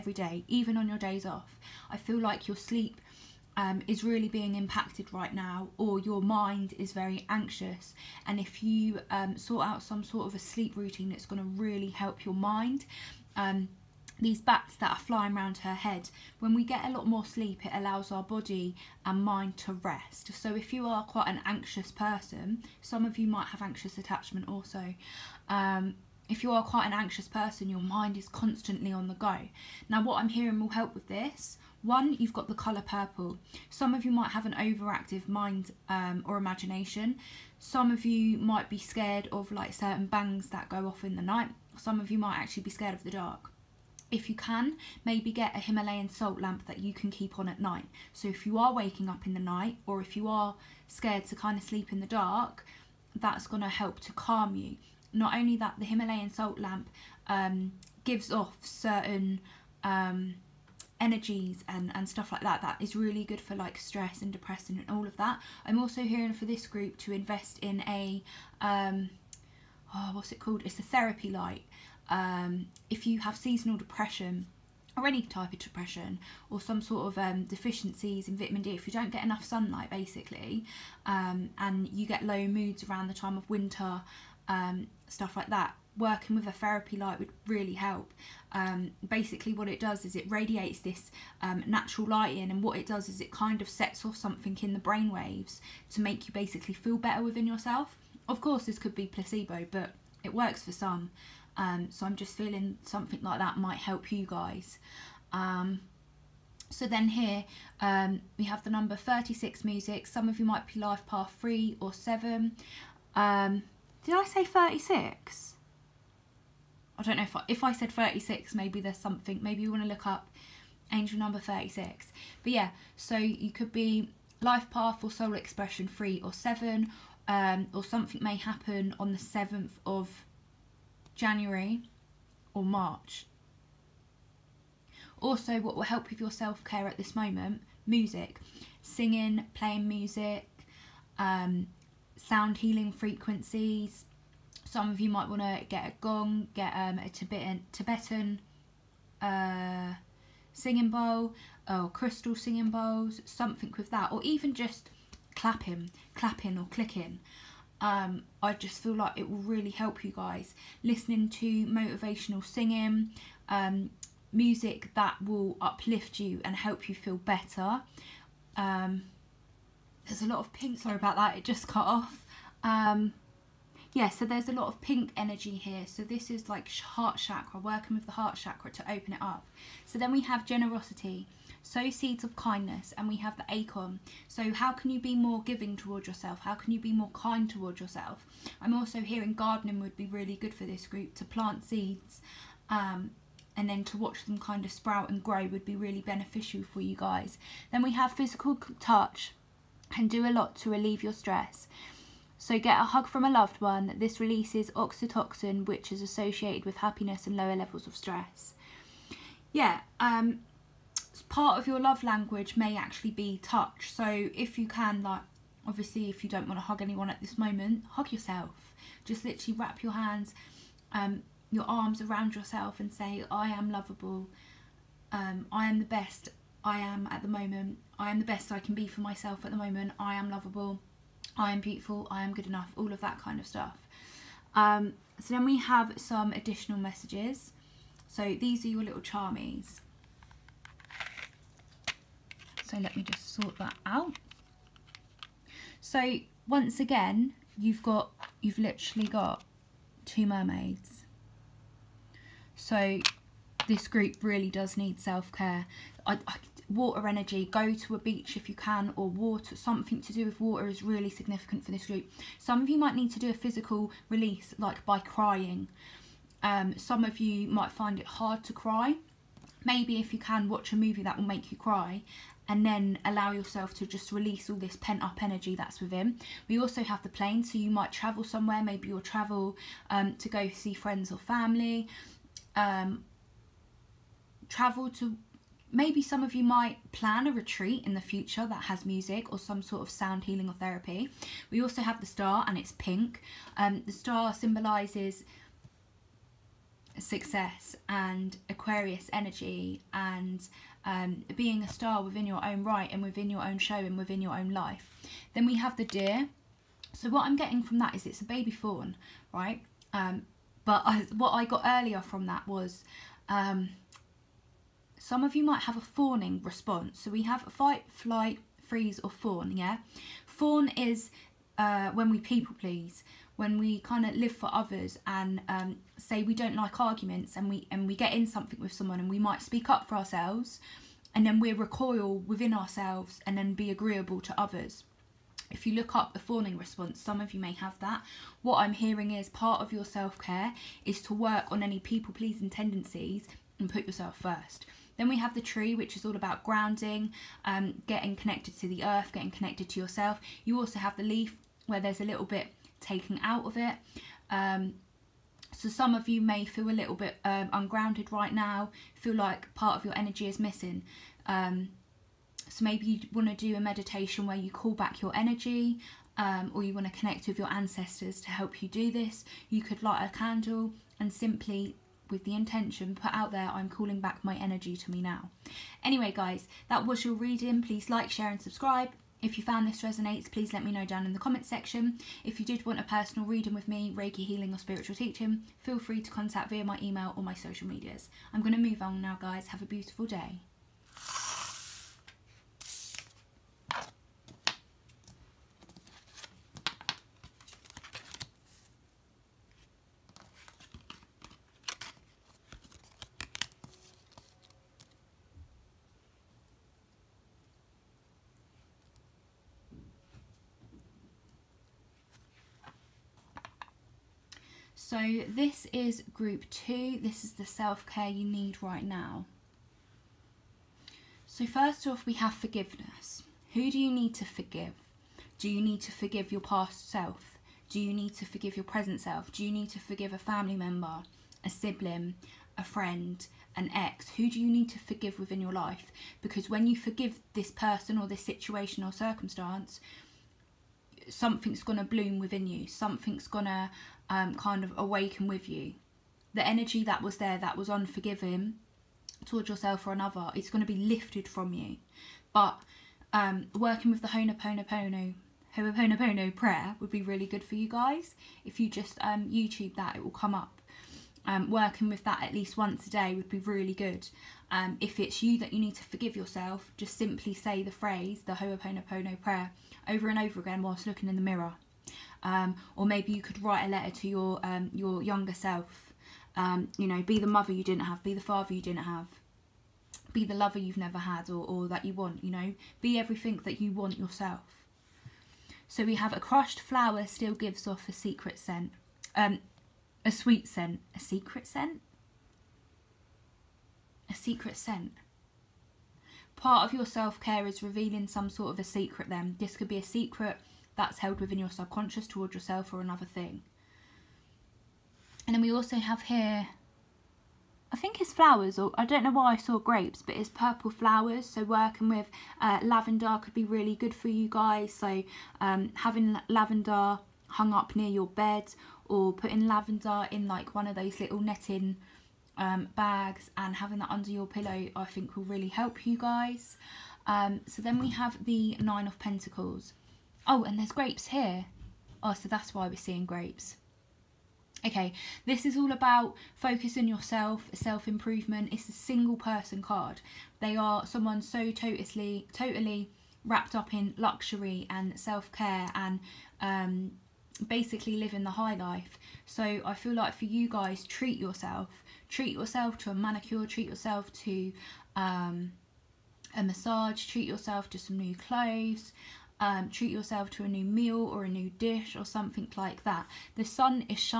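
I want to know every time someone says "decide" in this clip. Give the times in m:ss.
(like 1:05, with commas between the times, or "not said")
not said.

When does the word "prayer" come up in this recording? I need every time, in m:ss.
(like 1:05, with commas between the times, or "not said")
7:36, 7:49.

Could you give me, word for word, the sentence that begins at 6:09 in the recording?
You could light a candle and simply with the intention put out there I'm calling back my energy to me now.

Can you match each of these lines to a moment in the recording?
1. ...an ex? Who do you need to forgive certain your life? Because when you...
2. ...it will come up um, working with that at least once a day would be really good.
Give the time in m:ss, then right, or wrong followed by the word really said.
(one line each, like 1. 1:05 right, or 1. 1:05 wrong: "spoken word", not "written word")
1. 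7:13 wrong: "within", not "certain"
2. 7:39 right.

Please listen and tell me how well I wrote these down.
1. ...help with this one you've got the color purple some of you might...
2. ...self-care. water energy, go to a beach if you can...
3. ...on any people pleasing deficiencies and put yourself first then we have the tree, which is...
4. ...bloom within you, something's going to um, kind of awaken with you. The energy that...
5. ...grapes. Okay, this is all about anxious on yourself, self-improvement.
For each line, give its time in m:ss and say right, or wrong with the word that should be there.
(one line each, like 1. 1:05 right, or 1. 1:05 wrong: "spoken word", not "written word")
1. 0:30 right
2. 4:14 right
3. 5:41 wrong: "tendencies", not "deficiencies"
4. 7:21 right
5. 8:53 wrong: "focus", not "anxious".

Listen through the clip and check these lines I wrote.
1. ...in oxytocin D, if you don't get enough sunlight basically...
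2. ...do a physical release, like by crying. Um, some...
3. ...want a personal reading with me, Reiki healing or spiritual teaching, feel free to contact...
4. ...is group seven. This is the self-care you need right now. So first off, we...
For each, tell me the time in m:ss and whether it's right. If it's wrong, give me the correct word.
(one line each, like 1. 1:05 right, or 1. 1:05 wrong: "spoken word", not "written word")
1. 1:18 wrong: "vitamin", not "oxytocin"
2. 4:23 right
3. 6:22 right
4. 6:55 wrong: "two", not "seven".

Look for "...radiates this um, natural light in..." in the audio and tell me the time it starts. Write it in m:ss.
1:30.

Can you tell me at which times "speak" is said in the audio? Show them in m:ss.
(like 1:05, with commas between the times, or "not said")
5:29.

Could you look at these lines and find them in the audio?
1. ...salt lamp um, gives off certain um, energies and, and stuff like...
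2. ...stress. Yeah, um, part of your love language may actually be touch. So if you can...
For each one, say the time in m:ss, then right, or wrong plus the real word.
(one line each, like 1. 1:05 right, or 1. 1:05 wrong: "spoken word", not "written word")
1. 0:56 right
2. 3:27 right.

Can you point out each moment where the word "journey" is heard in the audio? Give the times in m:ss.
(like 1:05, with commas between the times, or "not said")
not said.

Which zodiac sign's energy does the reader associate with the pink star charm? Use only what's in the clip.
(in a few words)
Aquarius.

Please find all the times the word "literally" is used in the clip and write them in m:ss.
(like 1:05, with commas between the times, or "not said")
3:39, 4:08.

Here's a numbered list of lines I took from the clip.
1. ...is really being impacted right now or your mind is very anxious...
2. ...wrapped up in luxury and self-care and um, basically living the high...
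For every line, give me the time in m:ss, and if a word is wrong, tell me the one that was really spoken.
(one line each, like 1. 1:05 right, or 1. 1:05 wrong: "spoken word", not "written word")
1. 0:03 right
2. 9:03 right.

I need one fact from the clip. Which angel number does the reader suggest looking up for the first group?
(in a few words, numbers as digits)
36.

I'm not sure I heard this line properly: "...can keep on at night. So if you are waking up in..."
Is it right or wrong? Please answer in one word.
right.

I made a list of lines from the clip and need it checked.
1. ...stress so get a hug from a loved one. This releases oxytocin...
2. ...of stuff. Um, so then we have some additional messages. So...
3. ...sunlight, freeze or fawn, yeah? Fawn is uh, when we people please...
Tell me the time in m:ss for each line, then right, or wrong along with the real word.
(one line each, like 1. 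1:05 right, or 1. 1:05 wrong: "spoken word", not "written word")
1. 3:21 right
2. 3:53 right
3. 5:17 wrong: "flight", not "sunlight".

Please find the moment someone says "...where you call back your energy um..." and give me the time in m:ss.
6:04.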